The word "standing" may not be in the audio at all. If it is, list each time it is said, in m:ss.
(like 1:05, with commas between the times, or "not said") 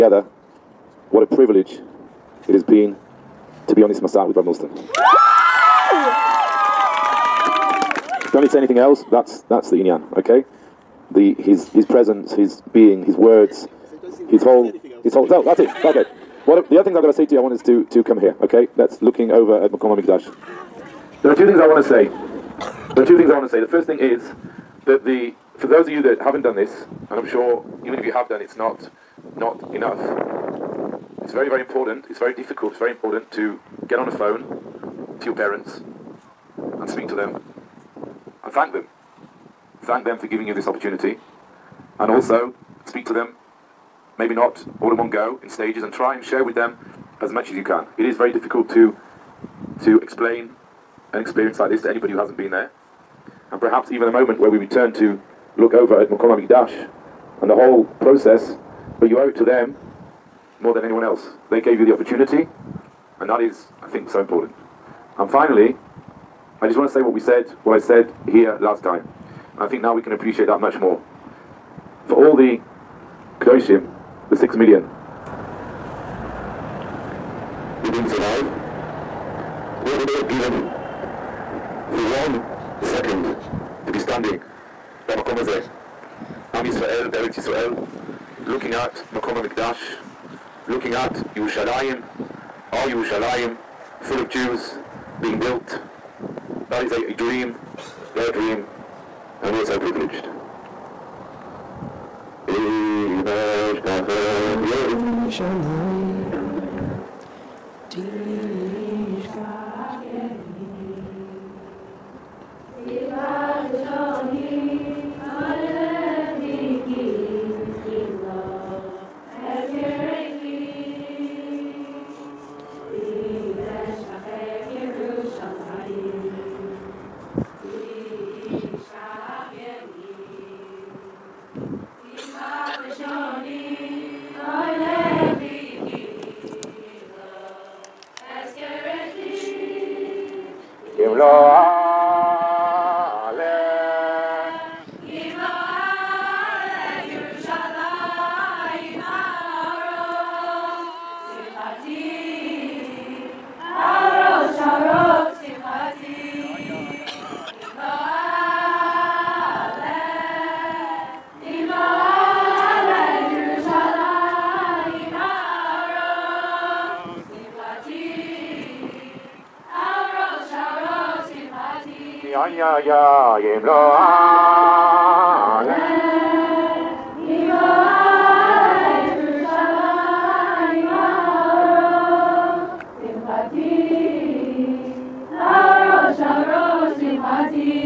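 1:23.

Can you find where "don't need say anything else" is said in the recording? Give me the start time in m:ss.
0:08.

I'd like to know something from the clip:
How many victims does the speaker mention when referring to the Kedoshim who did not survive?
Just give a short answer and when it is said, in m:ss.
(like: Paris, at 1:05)
6 million, at 1:14.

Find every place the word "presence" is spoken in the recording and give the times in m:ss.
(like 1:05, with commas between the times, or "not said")
0:11.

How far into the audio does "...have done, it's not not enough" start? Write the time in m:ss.
0:28.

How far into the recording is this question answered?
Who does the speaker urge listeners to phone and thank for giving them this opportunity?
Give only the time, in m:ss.
0:35.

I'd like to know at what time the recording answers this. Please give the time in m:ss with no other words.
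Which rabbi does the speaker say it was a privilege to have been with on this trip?
0:04.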